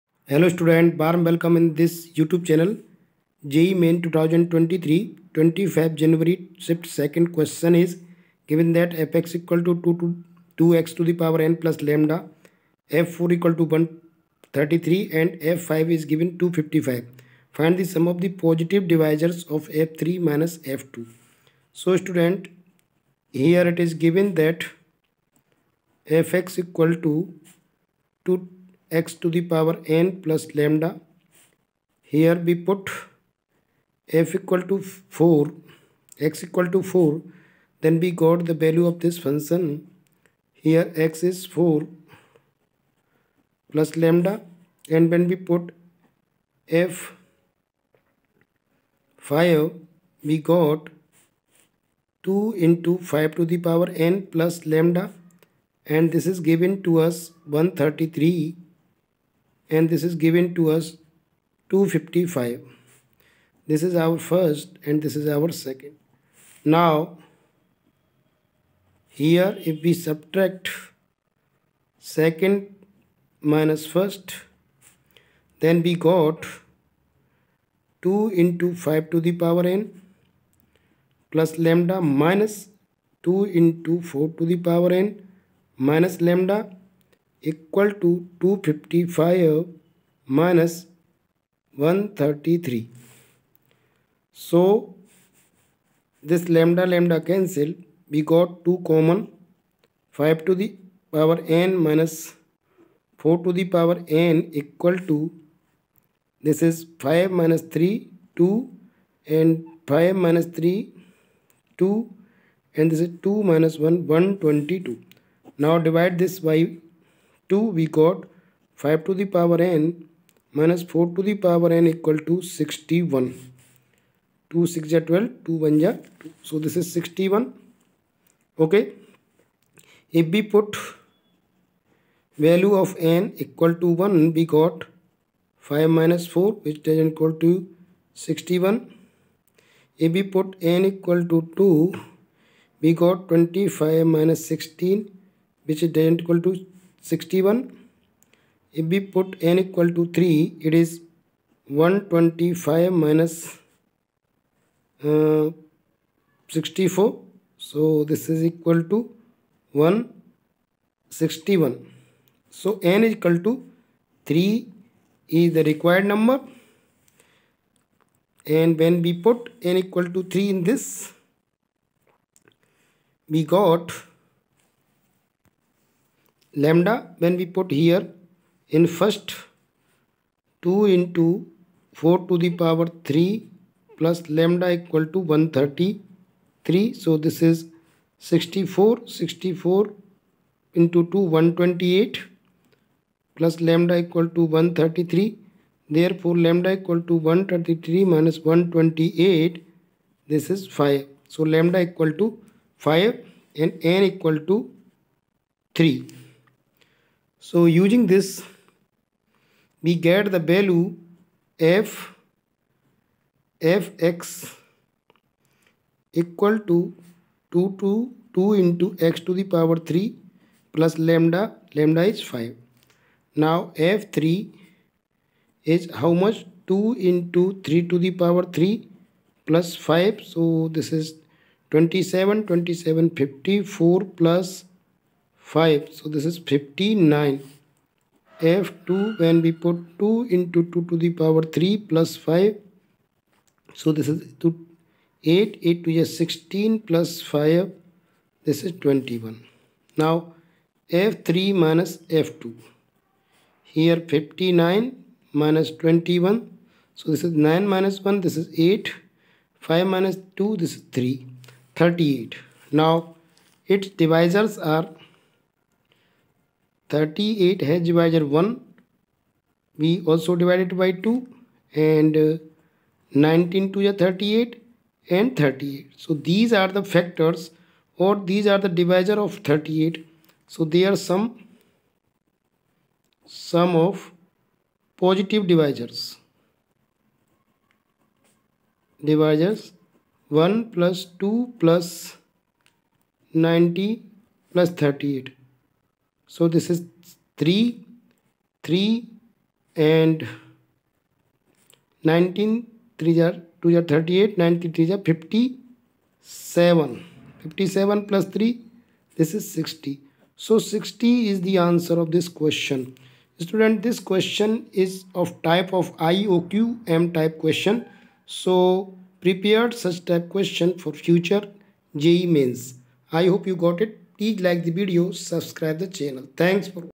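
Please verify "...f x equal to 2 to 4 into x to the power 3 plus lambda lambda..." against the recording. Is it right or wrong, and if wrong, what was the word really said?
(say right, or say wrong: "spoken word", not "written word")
wrong: "2", not "4".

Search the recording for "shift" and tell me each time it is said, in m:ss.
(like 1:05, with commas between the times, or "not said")
0:06.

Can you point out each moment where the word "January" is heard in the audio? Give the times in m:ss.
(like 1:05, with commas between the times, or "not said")
0:06.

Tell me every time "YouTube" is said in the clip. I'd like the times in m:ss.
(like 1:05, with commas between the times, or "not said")
0:02.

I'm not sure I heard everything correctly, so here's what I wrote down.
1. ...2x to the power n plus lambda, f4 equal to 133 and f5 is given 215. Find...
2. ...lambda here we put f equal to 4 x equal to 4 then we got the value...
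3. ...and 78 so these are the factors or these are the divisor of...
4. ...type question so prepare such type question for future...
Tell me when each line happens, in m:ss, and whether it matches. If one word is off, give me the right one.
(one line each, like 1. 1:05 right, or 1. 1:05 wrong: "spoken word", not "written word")
1. 0:10 wrong: "255", not "215"
2. 0:30 right
3. 4:35 wrong: "38", not "78"
4. 5:17 right.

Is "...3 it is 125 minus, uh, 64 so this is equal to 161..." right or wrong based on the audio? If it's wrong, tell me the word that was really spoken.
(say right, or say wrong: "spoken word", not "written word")
right.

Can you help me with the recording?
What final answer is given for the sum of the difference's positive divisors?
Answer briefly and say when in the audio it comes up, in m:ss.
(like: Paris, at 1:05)
60, at 5:10.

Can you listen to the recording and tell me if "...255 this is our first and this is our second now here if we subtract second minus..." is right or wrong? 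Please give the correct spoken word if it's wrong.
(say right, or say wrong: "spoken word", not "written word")
right.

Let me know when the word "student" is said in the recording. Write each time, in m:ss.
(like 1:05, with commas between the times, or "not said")
0:00, 0:21, 5:13.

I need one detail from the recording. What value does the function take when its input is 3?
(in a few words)
59.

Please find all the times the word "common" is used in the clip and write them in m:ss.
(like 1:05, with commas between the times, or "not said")
1:38.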